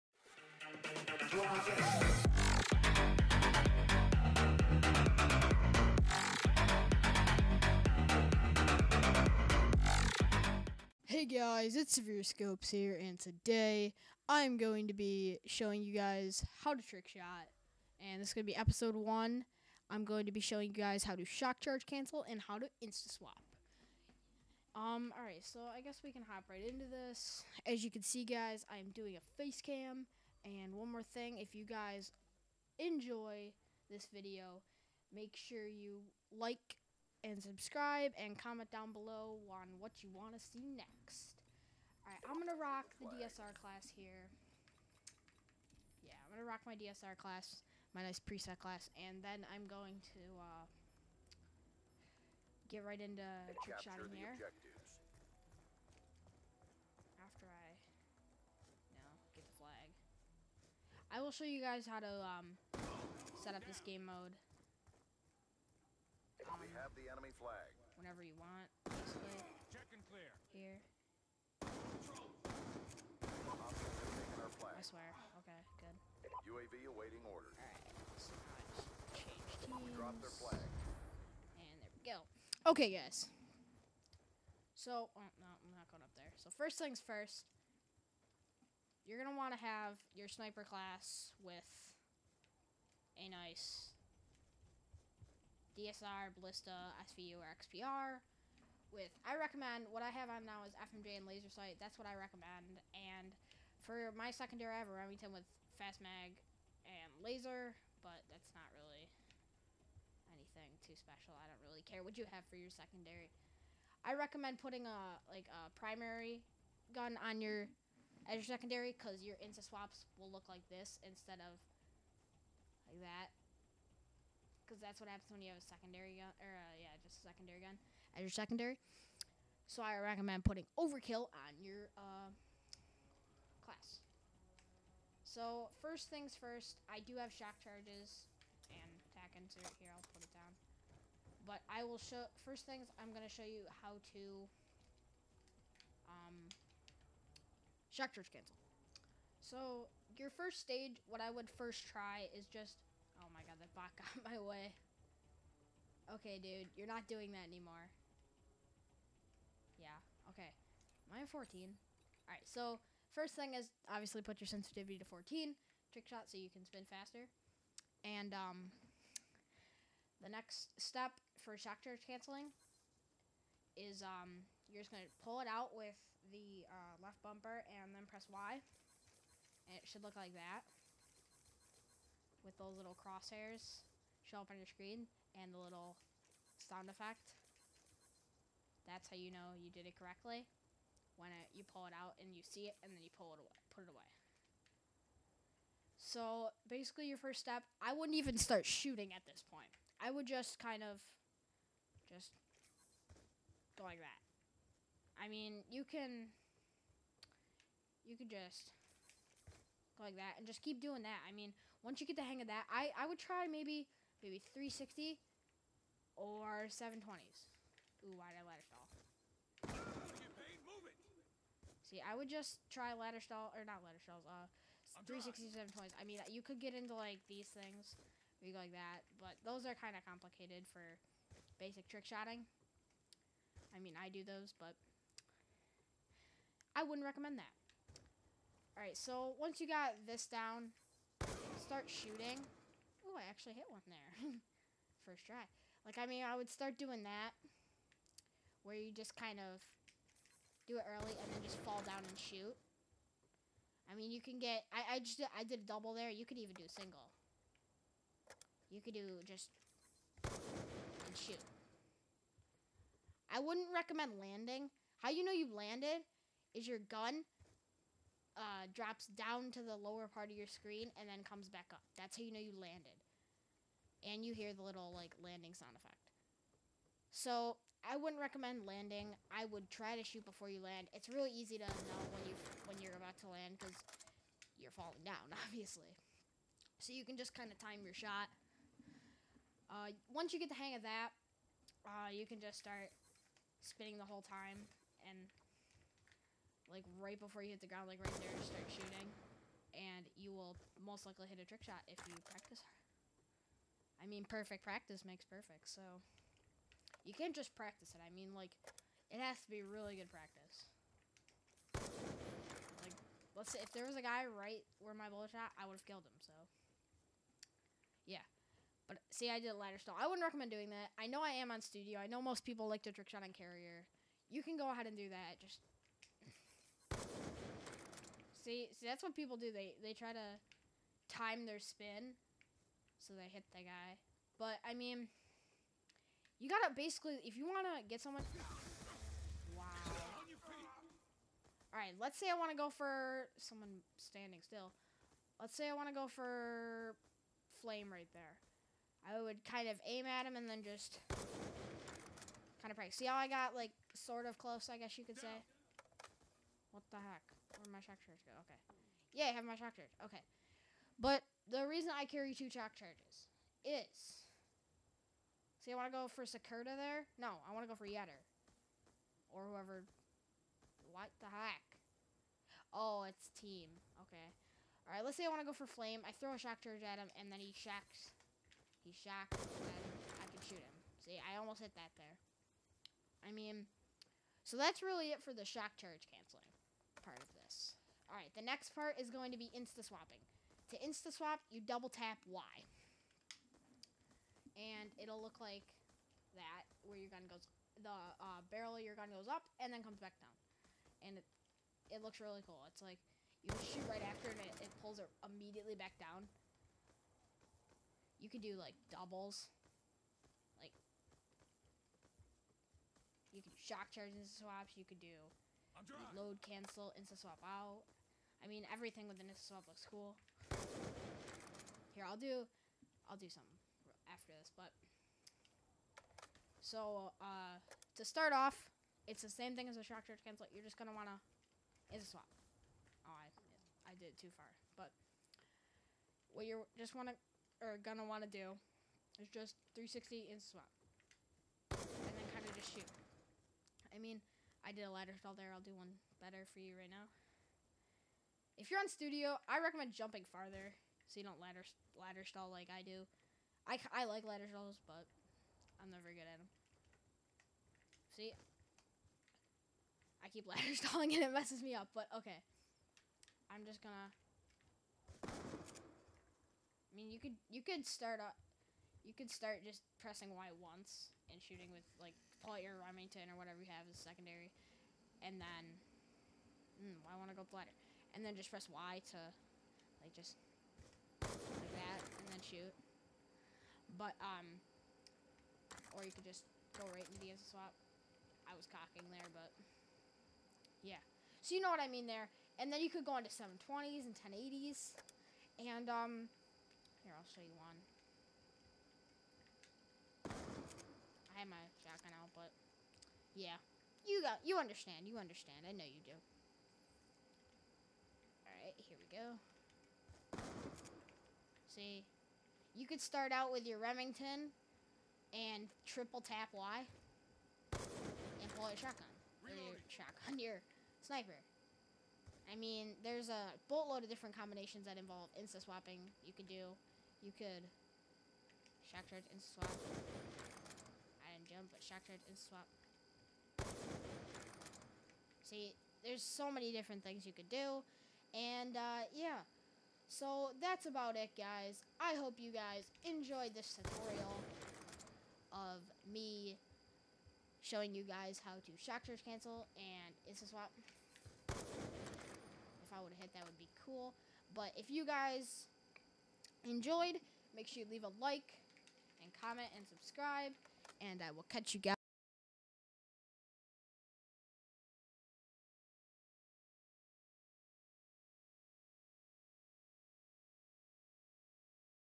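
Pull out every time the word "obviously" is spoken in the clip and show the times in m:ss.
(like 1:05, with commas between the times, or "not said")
2:43, 4:45.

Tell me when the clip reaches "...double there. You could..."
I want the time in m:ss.
4:15.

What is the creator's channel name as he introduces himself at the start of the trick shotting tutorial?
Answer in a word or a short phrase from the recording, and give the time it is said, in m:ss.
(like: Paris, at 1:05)
Severe ScopezZ, at 0:11.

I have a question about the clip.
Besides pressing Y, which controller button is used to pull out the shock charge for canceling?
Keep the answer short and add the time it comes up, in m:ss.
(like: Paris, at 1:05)
Left bumper, at 2:57.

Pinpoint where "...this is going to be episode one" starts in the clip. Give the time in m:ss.
0:18.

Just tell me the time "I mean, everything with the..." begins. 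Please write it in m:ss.
6:58.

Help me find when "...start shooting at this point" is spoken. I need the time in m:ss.
3:18.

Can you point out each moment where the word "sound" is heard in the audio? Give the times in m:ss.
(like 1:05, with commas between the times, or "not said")
3:06, 4:35.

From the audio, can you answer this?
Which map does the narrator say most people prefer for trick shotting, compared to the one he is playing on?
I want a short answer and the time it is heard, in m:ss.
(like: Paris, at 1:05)
Carrier, at 5:23.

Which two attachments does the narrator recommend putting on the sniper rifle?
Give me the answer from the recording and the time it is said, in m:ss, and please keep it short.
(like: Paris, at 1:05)
FMJ and laser sight, at 1:40.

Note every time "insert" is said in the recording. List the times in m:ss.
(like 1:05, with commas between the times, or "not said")
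2:19.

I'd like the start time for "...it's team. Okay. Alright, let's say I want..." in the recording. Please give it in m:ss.
6:13.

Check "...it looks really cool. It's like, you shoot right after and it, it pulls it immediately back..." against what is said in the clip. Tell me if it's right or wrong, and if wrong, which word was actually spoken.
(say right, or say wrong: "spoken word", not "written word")
right.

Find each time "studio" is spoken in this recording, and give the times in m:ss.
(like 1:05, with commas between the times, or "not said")
5:21, 7:28.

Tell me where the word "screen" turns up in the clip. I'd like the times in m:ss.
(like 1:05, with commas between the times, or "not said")
3:04, 4:30.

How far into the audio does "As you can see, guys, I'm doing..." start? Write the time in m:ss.
0:27.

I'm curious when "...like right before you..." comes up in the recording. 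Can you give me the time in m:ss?
4:56.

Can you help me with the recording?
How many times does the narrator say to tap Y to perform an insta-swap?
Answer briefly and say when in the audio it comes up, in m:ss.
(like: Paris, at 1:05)
2, at 6:31.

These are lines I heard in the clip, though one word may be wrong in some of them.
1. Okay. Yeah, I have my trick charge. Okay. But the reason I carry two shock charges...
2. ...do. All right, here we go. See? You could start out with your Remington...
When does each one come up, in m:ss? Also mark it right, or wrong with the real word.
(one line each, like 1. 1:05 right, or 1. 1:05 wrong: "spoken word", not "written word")
1. 5:58 wrong: "shock", not "trick"
2. 8:26 right.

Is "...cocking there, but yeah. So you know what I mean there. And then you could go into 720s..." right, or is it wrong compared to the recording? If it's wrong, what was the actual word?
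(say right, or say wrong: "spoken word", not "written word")
right.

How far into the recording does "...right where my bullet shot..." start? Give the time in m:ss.
5:14.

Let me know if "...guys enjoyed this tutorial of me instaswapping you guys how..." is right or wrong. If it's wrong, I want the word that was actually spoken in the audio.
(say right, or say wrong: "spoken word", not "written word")
wrong: "showing", not "instaswapping".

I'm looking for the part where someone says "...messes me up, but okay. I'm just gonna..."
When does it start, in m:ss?
7:41.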